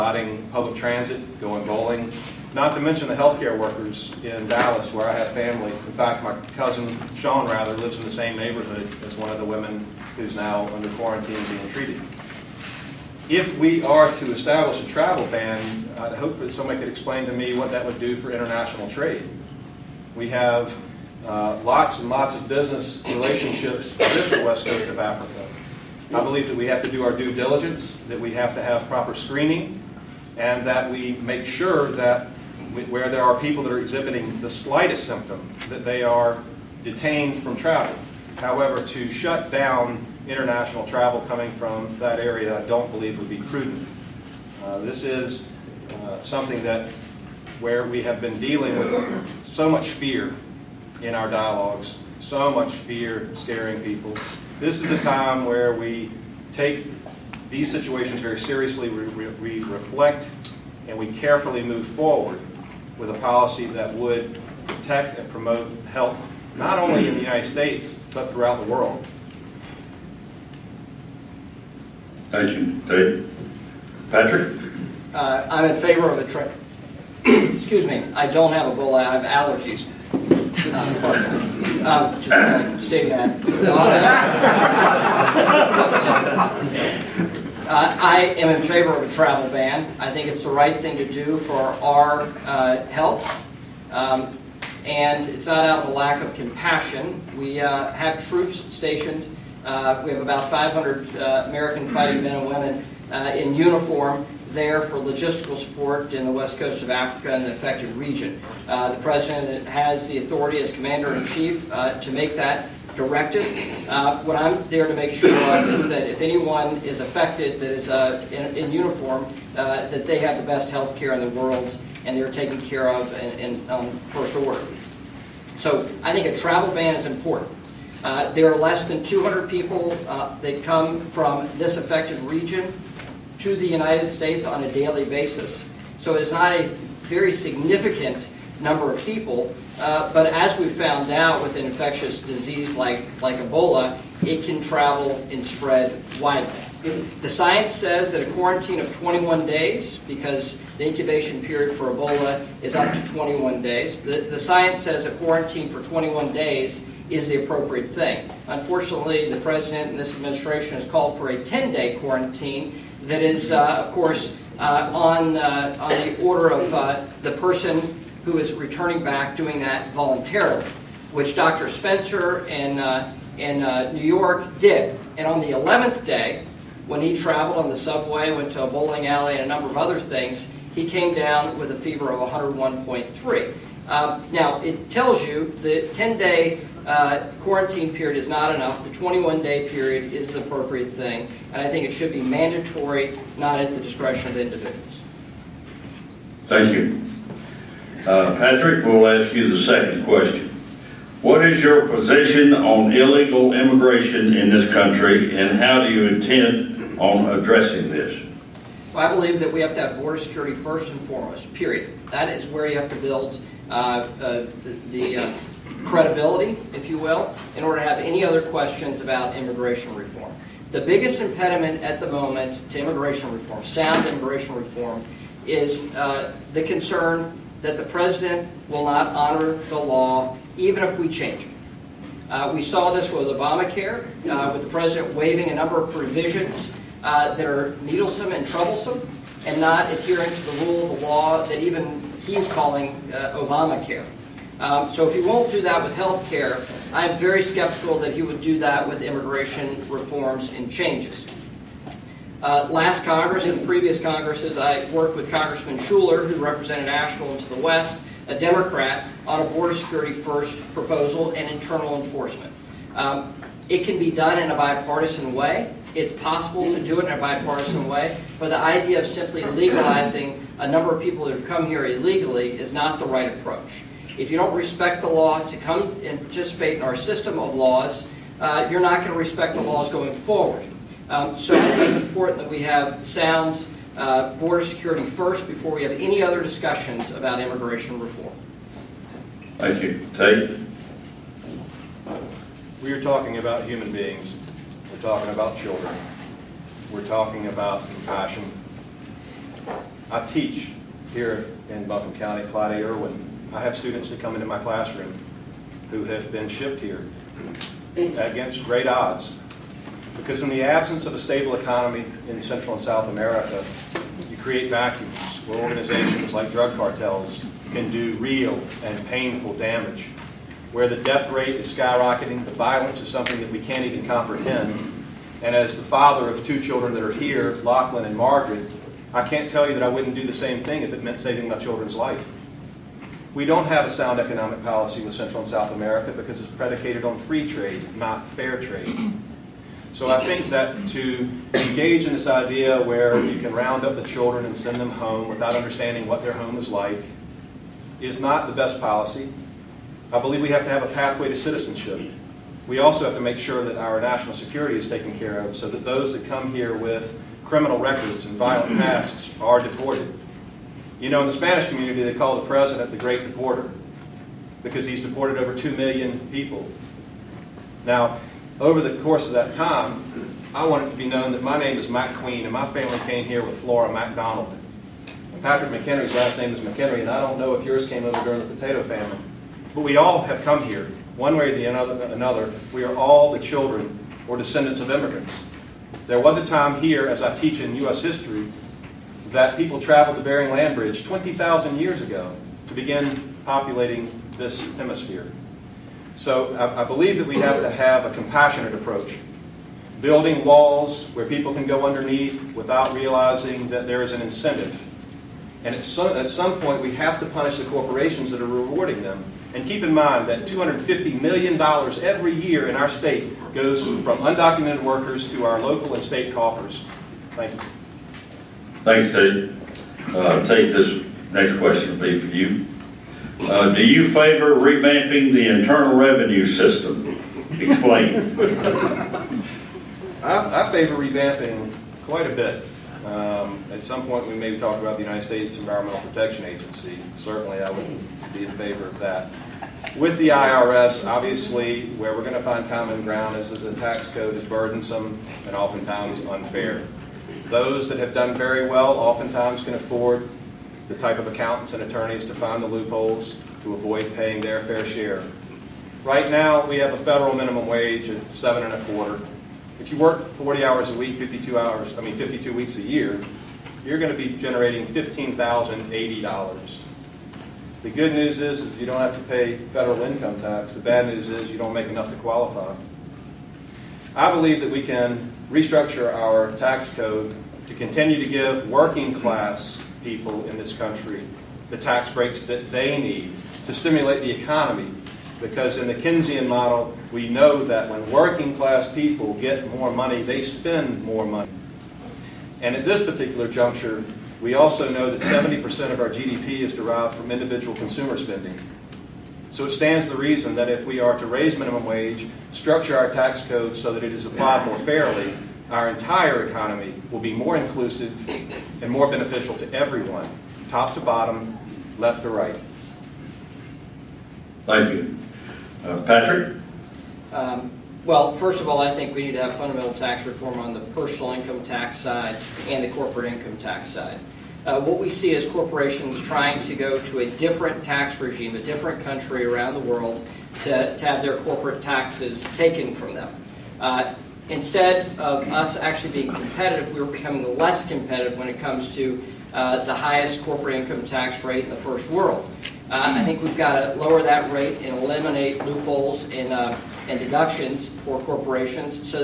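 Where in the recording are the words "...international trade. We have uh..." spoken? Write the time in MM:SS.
00:18.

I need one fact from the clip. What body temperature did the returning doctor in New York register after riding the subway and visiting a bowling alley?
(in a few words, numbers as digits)
101.3.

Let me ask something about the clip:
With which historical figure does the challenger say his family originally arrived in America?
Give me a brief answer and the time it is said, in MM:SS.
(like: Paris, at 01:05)
Flora MacDonald, at 06:13.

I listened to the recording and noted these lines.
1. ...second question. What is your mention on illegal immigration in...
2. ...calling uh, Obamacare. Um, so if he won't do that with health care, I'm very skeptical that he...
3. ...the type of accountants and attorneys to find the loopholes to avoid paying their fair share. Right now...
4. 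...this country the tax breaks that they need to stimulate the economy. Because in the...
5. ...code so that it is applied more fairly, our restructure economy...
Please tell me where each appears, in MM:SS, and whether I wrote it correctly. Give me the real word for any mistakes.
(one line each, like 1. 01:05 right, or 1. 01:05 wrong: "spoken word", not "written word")
1. 03:19 wrong: "position", not "mention"
2. 04:02 right
3. 07:30 right
4. 08:00 right
5. 08:23 wrong: "entire", not "restructure".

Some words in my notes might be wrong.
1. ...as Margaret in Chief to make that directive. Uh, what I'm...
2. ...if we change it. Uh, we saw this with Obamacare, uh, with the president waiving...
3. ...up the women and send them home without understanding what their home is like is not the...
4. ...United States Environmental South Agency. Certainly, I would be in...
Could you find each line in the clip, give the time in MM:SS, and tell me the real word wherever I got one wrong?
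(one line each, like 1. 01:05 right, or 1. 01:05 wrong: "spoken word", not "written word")
1. 01:50 wrong: "Commander", not "Margaret"
2. 03:50 right
3. 05:43 wrong: "children", not "women"
4. 07:15 wrong: "Protection", not "South".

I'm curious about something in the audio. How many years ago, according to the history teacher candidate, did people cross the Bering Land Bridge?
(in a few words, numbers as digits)
20,000.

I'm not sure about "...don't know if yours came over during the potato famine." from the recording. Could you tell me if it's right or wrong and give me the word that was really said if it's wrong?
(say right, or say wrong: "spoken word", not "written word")
right.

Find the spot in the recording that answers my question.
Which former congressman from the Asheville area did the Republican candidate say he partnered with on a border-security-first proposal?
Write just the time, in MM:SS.
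04:15.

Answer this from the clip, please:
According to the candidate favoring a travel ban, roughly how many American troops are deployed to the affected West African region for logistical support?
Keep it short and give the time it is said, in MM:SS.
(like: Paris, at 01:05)
500, at 01:40.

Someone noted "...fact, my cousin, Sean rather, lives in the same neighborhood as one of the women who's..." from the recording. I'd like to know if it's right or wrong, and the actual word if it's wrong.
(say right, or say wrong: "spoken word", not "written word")
right.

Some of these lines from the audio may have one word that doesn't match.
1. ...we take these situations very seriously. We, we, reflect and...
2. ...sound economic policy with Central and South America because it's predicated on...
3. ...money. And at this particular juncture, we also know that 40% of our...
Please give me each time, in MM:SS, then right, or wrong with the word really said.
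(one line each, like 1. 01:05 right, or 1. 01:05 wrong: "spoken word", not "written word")
1. 00:55 right
2. 05:33 right
3. 08:11 wrong: "70", not "40".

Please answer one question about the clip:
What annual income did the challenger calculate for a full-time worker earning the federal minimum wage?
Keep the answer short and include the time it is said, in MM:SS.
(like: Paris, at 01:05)
$15,080, at 07:44.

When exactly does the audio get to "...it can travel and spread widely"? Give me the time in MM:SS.
02:24.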